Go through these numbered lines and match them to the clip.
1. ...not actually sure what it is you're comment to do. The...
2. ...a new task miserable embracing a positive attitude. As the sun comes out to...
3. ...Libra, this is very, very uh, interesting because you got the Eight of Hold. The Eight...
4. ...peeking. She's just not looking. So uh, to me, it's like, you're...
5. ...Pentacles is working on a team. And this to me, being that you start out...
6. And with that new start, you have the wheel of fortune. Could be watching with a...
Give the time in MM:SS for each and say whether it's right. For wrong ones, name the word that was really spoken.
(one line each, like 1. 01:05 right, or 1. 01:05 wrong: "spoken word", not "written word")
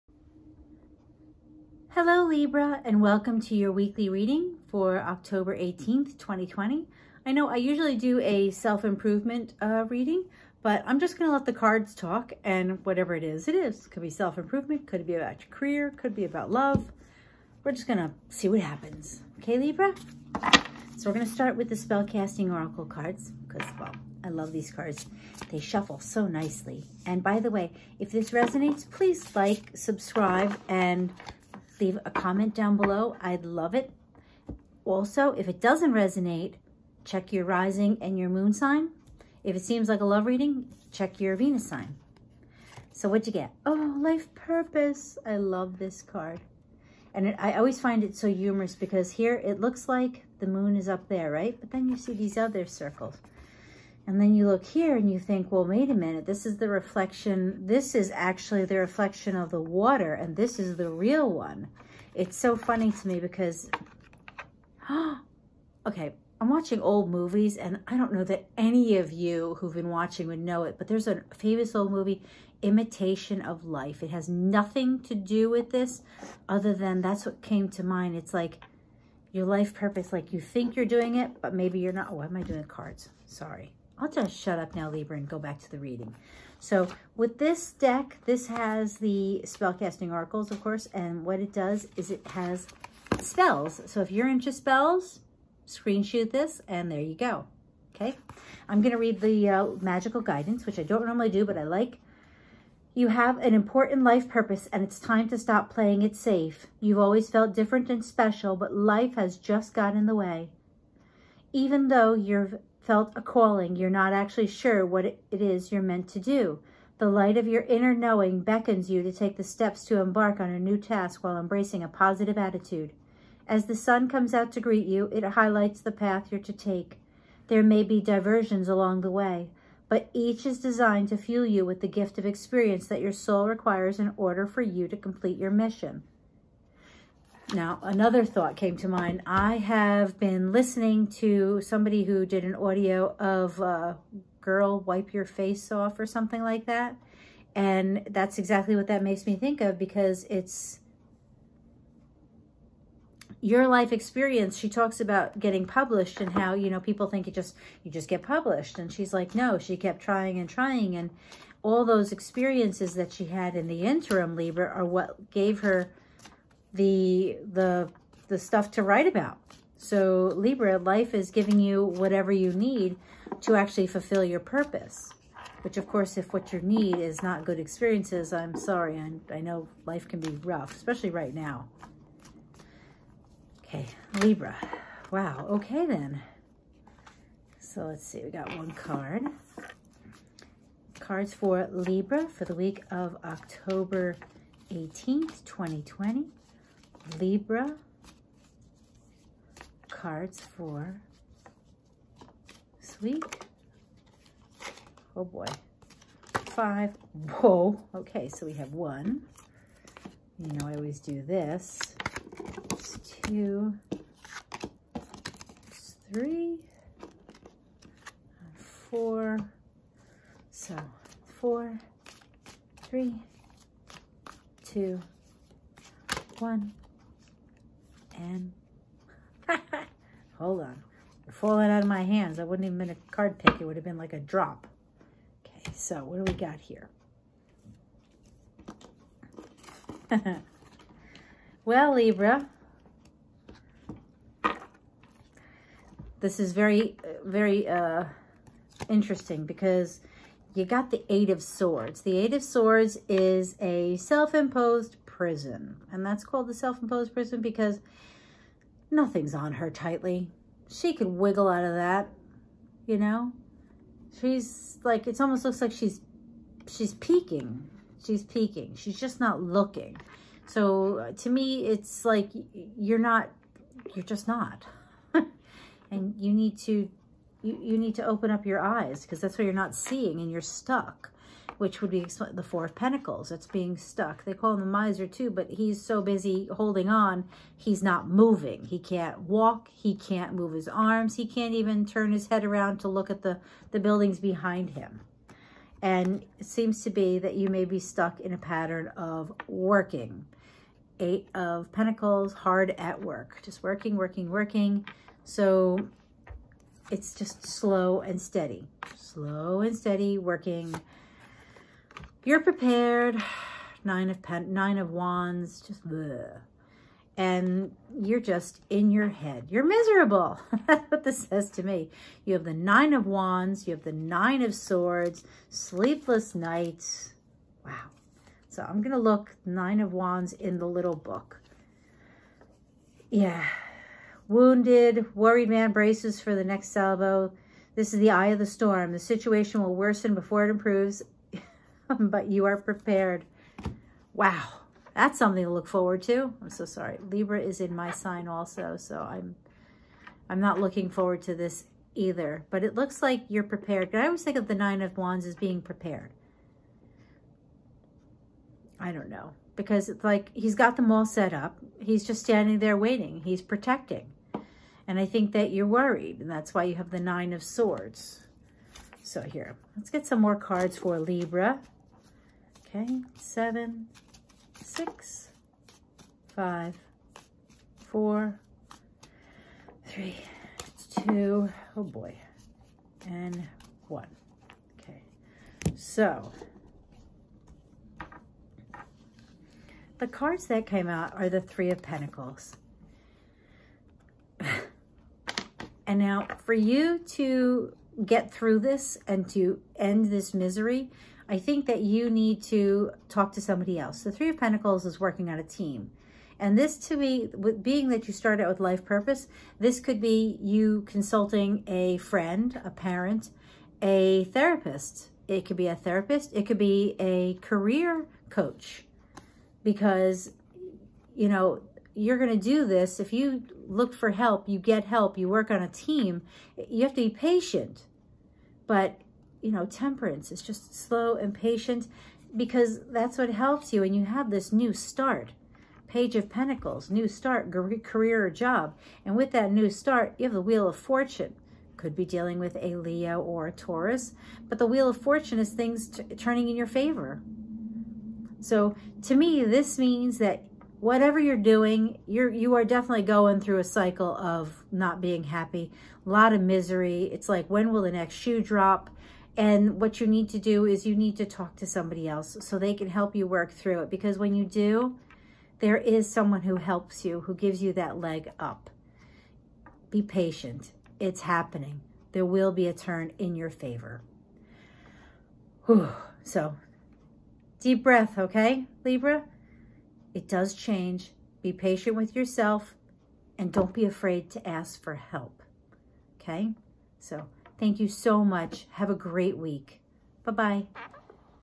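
1. 01:53 wrong: "meant", not "comment"
2. 02:00 wrong: "while", not "miserable"
3. 04:01 wrong: "Swords", not "Hold"
4. 04:28 right
5. 06:44 right
6. 07:19 wrong: "dealing", not "watching".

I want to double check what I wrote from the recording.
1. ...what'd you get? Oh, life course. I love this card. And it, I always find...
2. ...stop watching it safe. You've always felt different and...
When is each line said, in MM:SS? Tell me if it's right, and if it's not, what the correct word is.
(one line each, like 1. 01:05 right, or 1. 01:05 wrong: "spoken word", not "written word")
1. 00:43 wrong: "purpose", not "course"
2. 01:45 wrong: "playing", not "watching".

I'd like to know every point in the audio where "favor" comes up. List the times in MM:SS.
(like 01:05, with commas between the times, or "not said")
07:26, 07:53.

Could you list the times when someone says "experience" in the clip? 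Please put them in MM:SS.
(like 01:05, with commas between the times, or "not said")
02:12, 02:33, 02:42, 02:57.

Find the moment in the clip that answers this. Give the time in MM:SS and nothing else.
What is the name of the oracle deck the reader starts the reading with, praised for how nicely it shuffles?
00:21.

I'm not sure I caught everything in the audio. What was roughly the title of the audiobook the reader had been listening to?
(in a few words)
Girl Wipe Your Face Off.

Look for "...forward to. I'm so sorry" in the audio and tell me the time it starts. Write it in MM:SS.
05:45.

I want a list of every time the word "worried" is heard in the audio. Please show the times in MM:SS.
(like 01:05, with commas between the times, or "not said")
05:35, 06:05.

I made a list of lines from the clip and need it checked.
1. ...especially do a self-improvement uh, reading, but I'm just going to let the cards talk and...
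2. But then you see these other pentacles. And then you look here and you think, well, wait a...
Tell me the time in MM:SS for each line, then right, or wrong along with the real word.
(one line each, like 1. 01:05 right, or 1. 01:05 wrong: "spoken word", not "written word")
1. 00:07 wrong: "usually", not "especially"
2. 00:51 wrong: "circles", not "pentacles".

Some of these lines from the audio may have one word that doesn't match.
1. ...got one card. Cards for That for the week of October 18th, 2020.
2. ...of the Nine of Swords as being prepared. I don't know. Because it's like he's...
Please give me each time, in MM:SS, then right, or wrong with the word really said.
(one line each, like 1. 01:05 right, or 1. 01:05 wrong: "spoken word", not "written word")
1. 03:08 wrong: "Libra", not "That"
2. 05:54 wrong: "Wands", not "Swords".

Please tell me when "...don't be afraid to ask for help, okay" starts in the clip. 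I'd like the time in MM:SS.
08:03.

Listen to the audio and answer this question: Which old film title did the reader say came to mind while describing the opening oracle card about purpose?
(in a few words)
Imitation of Life.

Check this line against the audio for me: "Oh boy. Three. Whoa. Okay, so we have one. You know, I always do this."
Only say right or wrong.
wrong.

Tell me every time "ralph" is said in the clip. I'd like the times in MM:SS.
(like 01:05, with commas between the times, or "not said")
not said.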